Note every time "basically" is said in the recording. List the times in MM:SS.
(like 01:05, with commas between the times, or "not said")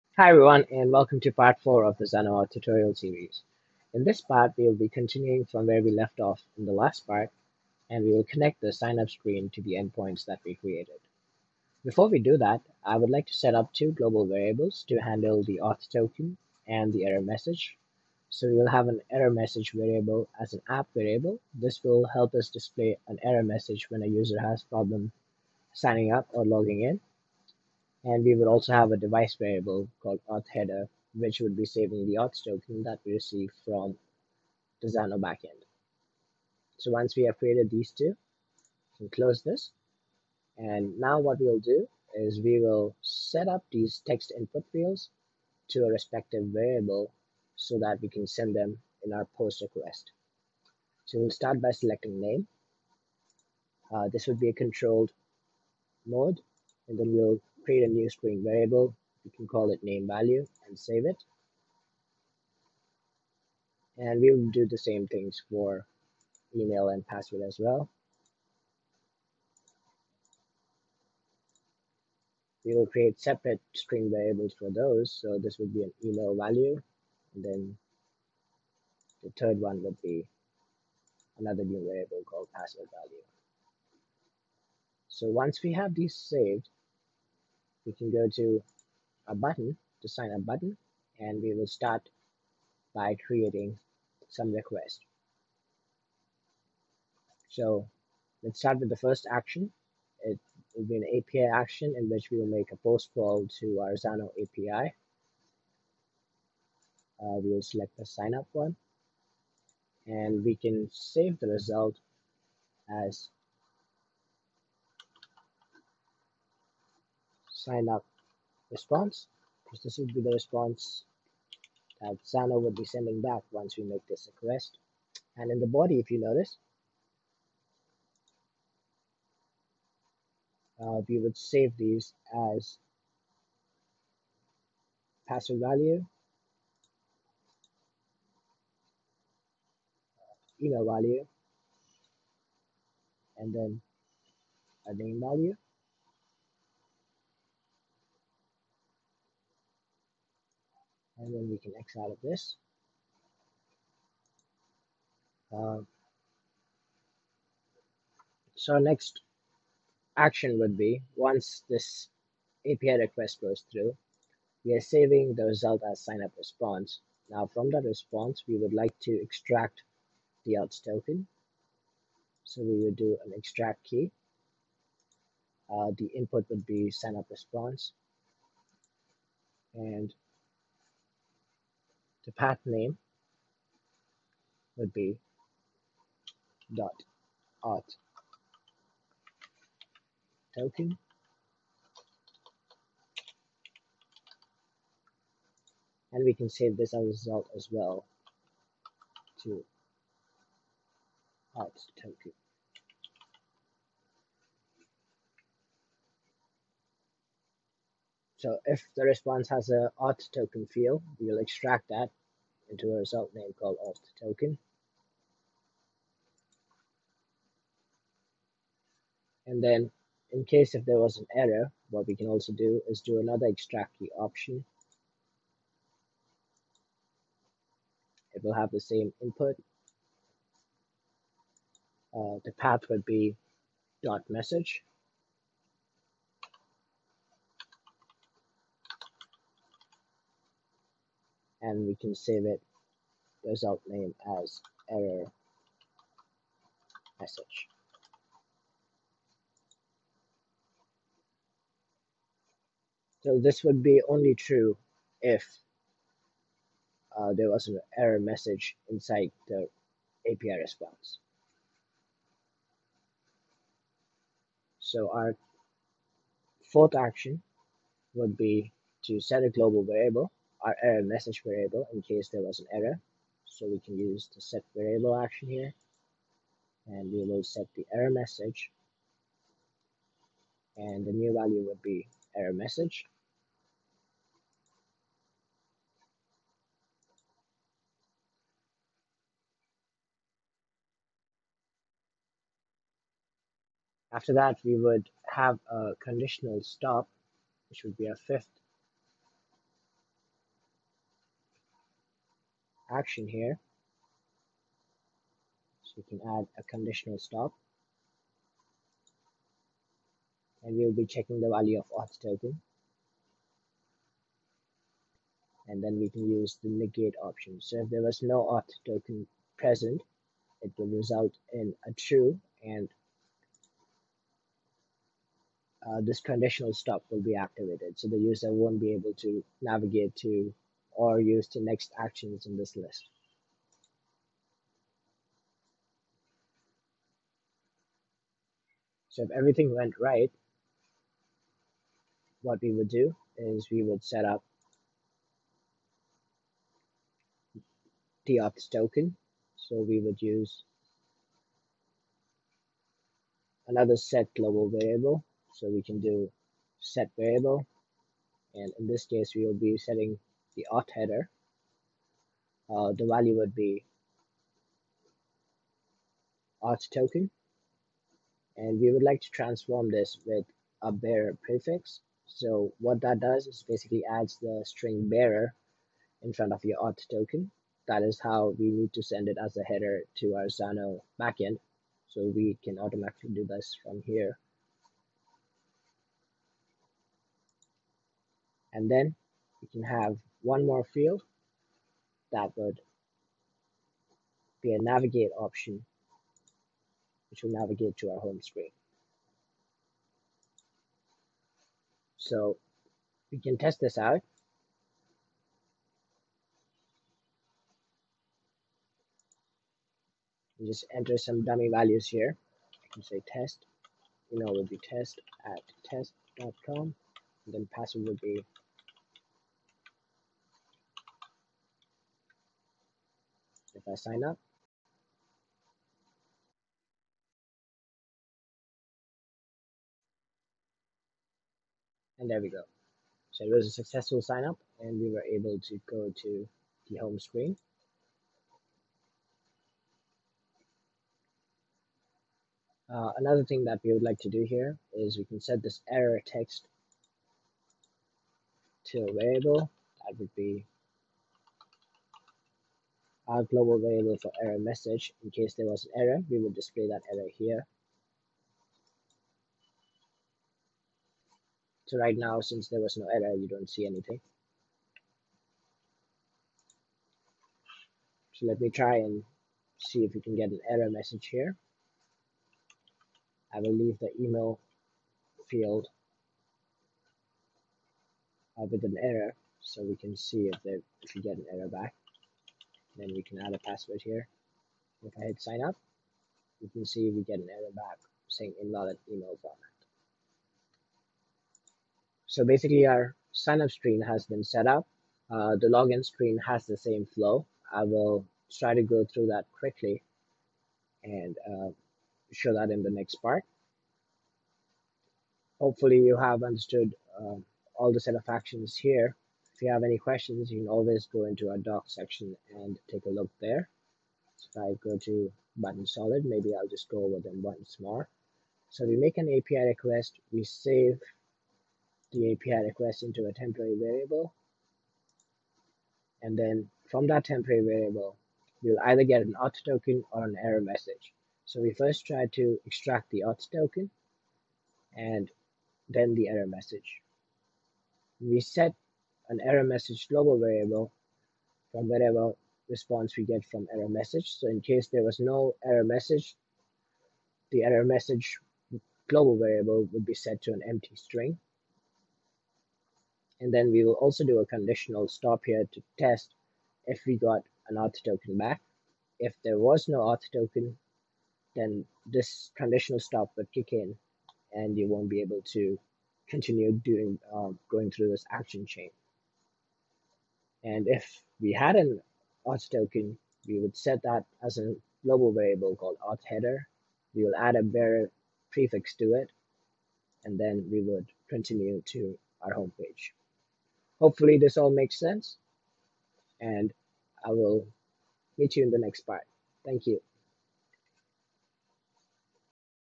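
06:13, 08:12.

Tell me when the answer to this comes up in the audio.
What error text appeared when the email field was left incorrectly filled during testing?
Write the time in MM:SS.
08:08.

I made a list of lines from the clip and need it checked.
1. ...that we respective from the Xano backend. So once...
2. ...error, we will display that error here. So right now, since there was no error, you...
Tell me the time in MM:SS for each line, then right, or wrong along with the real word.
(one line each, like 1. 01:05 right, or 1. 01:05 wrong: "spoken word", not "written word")
1. 00:32 wrong: "receive", not "respective"
2. 07:36 right.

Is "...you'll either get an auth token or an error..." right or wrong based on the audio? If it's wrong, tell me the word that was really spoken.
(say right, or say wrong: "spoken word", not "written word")
right.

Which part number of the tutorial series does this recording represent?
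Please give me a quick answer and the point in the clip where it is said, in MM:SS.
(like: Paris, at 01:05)
4, at 00:01.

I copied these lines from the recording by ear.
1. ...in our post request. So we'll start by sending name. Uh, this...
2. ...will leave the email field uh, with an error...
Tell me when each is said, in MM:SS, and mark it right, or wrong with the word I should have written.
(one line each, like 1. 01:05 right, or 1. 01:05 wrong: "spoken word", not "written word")
1. 00:49 wrong: "selecting", not "sending"
2. 07:53 right.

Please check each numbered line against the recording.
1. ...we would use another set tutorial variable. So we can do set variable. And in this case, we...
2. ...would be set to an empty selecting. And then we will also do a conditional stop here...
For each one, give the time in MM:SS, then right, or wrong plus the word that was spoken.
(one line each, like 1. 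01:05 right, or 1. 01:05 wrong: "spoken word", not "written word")
1. 05:49 wrong: "global", not "tutorial"
2. 09:09 wrong: "string", not "selecting".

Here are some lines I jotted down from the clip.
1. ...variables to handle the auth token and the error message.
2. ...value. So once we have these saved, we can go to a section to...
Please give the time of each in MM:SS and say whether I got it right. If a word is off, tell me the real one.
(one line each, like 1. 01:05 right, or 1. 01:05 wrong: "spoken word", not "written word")
1. 00:14 right
2. 01:22 wrong: "button", not "section".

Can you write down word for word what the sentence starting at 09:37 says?
We will add a bearer prefix to it, and then we would continue to our home page.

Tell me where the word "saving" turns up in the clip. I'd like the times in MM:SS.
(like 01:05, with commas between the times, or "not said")
00:31, 02:44.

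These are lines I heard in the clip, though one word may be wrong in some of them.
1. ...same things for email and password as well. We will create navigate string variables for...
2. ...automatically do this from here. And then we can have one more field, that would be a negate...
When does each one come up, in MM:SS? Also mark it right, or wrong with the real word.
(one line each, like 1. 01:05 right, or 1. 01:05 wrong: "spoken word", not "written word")
1. 01:04 wrong: "separate", not "navigate"
2. 06:22 wrong: "navigate", not "negate".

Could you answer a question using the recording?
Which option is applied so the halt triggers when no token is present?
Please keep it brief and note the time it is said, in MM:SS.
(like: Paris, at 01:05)
negate, at 05:16.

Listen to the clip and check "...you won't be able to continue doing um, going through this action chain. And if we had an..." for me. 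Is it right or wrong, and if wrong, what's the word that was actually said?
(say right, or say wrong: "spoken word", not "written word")
right.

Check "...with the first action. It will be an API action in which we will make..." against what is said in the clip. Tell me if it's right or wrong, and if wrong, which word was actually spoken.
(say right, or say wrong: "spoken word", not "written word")
right.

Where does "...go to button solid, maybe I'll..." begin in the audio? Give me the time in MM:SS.
08:34.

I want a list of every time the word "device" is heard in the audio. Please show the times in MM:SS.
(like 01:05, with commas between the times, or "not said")
00:28.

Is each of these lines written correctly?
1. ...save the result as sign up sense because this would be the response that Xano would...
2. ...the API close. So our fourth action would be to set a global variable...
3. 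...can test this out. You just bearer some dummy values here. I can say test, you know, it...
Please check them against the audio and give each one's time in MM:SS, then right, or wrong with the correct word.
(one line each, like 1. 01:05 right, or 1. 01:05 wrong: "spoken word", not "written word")
1. 01:50 wrong: "response", not "sense"
2. 04:19 wrong: "response", not "close"
3. 06:43 wrong: "enter", not "bearer".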